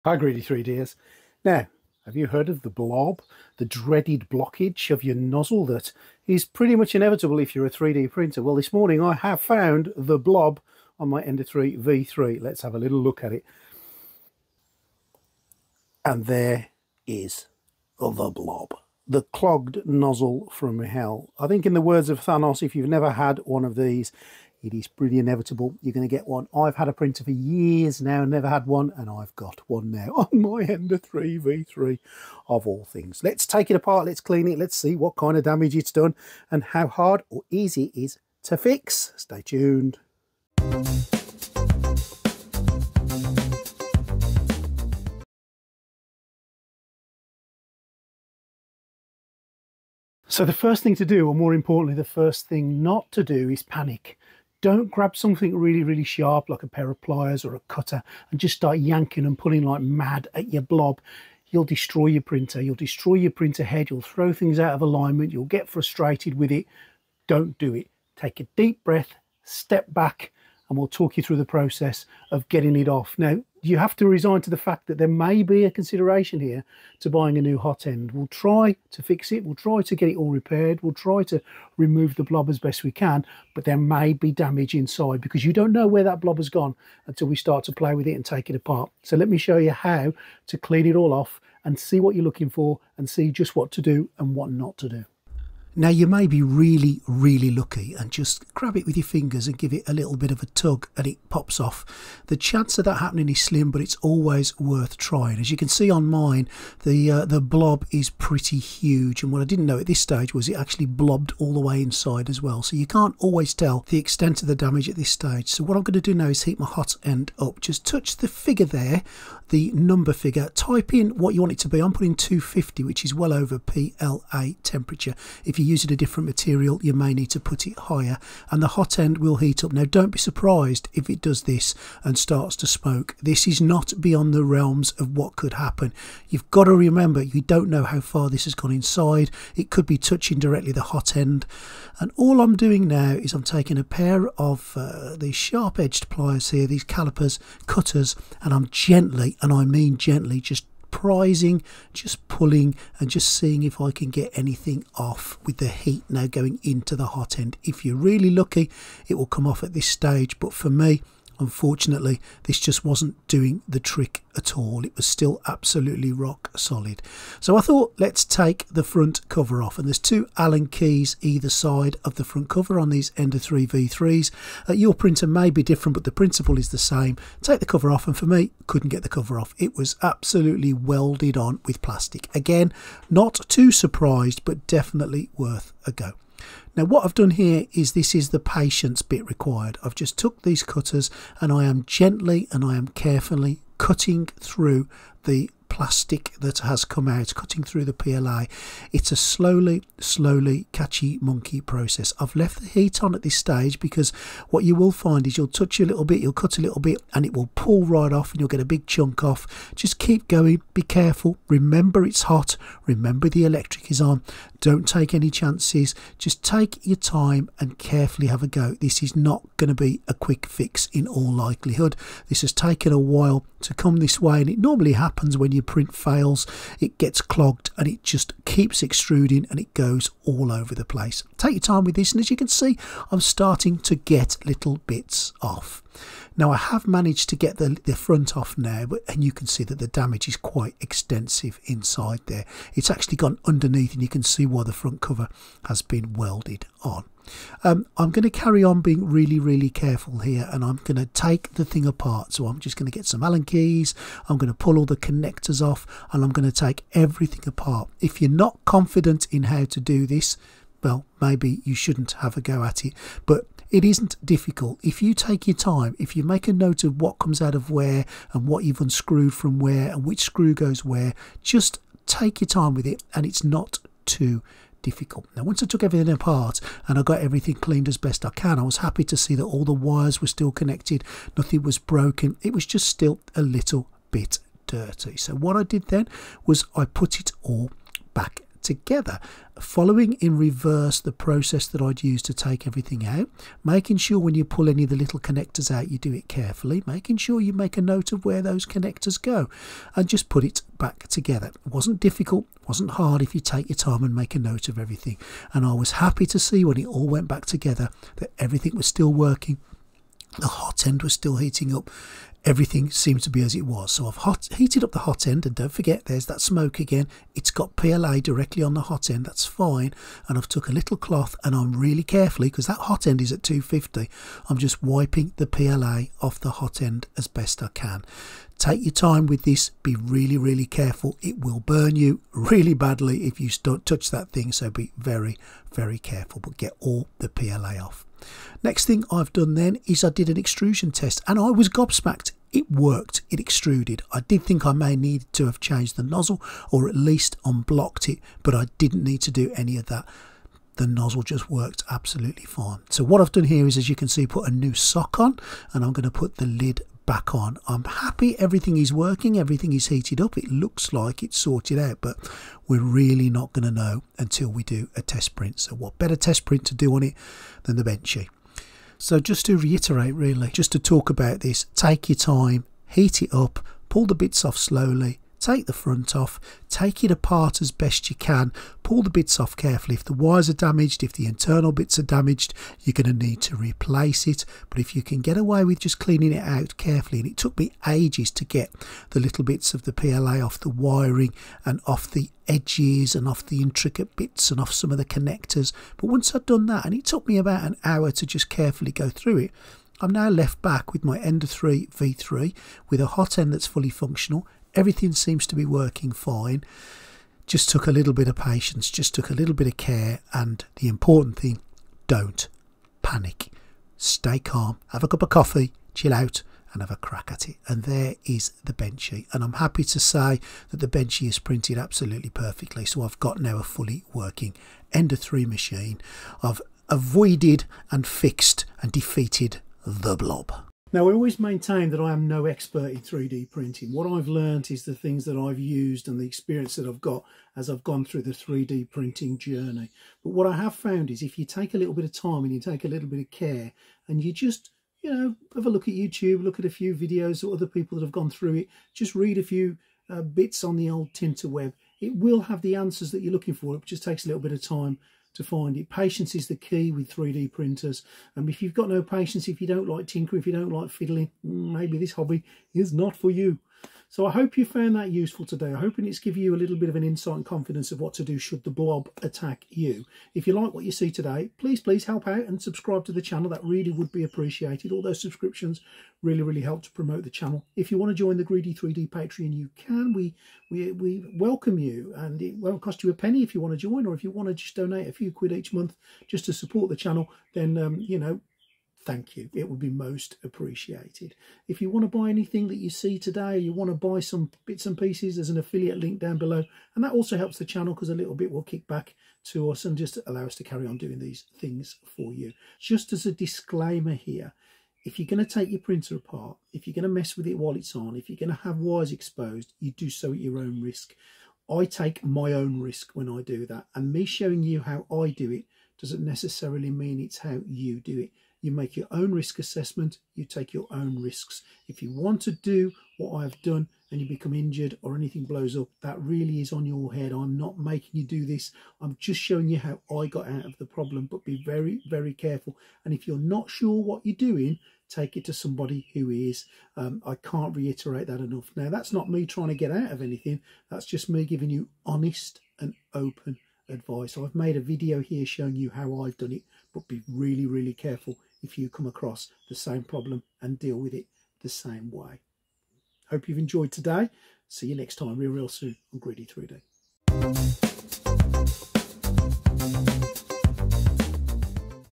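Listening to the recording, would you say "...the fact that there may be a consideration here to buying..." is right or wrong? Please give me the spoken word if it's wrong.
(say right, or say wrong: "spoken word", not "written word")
right.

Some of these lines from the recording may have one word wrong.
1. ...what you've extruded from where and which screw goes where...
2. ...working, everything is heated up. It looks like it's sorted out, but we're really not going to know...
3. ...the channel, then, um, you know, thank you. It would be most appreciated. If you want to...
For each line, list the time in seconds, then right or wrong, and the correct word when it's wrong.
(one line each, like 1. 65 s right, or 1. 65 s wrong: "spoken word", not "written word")
1. 268 s wrong: "unscrewed", not "extruded"
2. 358 s right
3. 486 s right.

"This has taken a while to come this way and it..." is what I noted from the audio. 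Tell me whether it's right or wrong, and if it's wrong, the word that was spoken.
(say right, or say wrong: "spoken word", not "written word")
right.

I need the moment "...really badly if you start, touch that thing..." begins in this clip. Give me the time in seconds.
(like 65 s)
332 s.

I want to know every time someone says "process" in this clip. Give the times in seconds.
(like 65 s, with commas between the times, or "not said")
71 s, 201 s, 291 s.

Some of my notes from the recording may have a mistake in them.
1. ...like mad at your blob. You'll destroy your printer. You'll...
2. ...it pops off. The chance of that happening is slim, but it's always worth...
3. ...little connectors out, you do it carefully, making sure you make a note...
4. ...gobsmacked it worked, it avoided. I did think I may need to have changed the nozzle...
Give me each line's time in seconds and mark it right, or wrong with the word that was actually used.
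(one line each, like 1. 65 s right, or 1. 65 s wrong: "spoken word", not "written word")
1. 59 s right
2. 101 s right
3. 294 s right
4. 341 s wrong: "extruded", not "avoided".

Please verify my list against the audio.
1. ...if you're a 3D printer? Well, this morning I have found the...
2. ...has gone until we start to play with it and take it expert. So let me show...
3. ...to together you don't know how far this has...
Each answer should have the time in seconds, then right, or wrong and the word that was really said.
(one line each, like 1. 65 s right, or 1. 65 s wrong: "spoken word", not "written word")
1. 7 s right
2. 86 s wrong: "apart", not "expert"
3. 136 s wrong: "remember", not "together".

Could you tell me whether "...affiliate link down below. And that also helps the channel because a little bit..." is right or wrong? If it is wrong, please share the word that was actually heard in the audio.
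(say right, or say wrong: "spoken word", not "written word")
right.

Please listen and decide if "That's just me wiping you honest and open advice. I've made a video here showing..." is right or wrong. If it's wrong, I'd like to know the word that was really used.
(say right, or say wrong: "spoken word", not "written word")
wrong: "giving", not "wiping".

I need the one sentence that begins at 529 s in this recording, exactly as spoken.
I'm just showing you how I got out of the problem, but be very, very careful.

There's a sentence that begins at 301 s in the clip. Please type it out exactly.
It wasn't difficult, wasn't hard if you take your time and make a note of everything.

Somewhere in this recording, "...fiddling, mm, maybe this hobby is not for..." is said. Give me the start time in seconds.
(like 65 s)
460 s.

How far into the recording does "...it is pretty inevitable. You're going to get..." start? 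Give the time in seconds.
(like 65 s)
24 s.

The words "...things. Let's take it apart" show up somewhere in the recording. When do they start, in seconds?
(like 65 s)
32 s.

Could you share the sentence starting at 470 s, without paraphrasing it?
If you like what you see today, please, please help out and subscribe to the channel.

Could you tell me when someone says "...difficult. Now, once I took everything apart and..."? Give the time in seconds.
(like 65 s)
274 s.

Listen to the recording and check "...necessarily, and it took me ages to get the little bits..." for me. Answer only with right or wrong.
wrong.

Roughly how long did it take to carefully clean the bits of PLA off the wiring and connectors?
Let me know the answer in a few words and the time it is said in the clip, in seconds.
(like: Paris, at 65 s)
about an hour, at 397 s.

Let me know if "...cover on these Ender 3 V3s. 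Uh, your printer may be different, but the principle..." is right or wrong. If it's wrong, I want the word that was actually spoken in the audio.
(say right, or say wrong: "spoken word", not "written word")
right.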